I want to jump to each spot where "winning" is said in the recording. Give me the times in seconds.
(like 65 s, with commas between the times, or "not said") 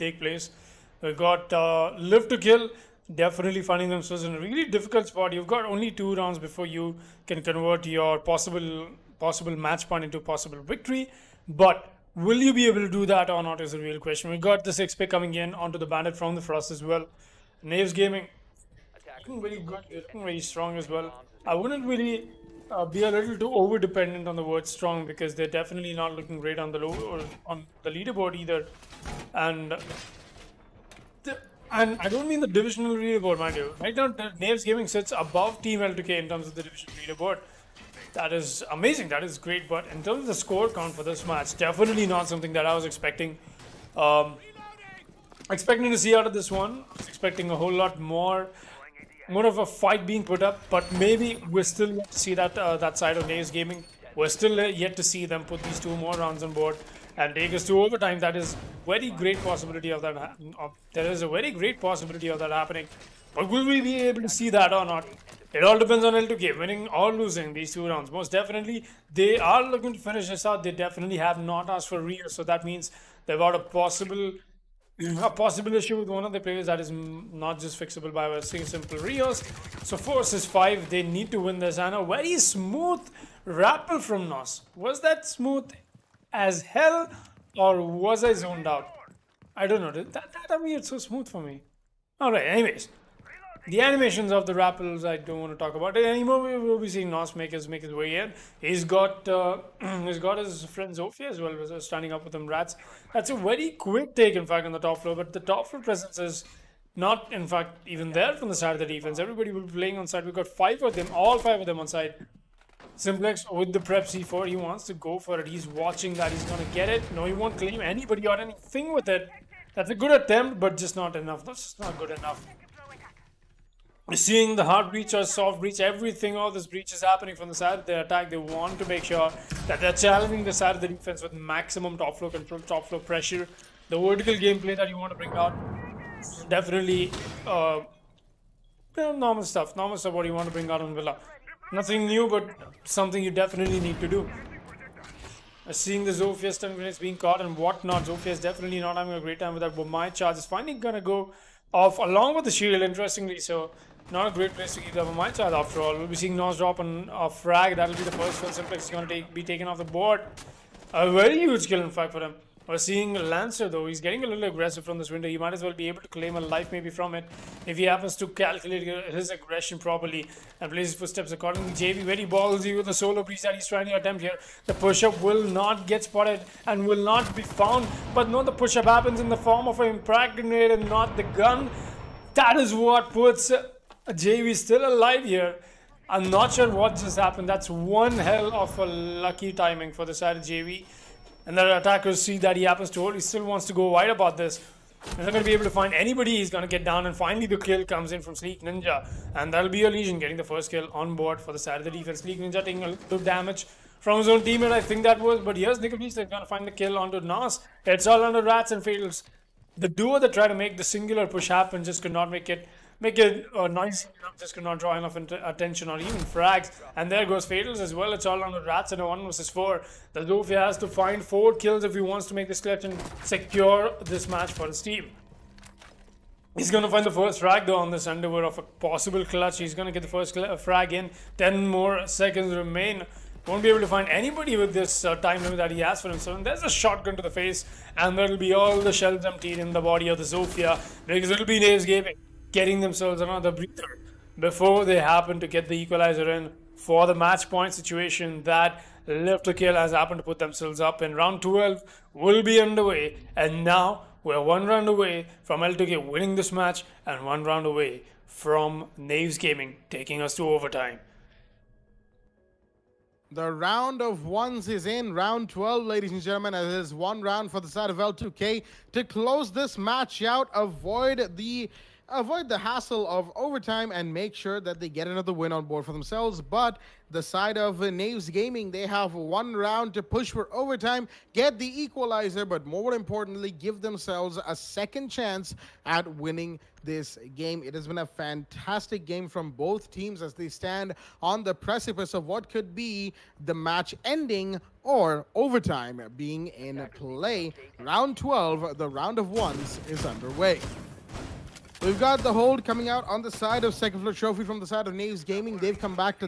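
66 s, 256 s, 286 s.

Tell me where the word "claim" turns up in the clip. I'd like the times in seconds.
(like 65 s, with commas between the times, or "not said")
117 s, 166 s.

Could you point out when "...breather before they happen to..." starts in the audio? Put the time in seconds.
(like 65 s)
243 s.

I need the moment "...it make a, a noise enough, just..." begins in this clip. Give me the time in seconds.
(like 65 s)
212 s.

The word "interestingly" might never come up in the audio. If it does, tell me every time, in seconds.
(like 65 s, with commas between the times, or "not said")
152 s.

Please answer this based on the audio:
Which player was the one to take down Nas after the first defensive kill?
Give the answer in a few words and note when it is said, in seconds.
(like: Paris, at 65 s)
Nickel Beast, at 205 s.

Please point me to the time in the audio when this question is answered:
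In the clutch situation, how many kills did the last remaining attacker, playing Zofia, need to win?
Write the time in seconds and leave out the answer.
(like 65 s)
220 s.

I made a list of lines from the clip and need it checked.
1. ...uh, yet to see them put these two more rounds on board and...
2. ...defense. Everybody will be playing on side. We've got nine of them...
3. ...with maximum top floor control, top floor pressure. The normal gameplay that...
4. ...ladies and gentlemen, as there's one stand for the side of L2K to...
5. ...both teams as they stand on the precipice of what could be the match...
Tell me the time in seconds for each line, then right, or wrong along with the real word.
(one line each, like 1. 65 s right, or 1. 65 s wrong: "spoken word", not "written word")
1. 54 s right
2. 108 s wrong: "five", not "nine"
3. 131 s wrong: "vertical", not "normal"
4. 265 s wrong: "round", not "stand"
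5. 289 s right.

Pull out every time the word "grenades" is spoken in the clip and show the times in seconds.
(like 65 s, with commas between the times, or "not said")
146 s, 180 s.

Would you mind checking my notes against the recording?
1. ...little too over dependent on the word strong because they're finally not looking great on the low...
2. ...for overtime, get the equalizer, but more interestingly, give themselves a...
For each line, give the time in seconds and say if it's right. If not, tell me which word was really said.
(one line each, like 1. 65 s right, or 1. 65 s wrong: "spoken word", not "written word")
1. 23 s wrong: "definitely", not "finally"
2. 280 s wrong: "importantly", not "interestingly".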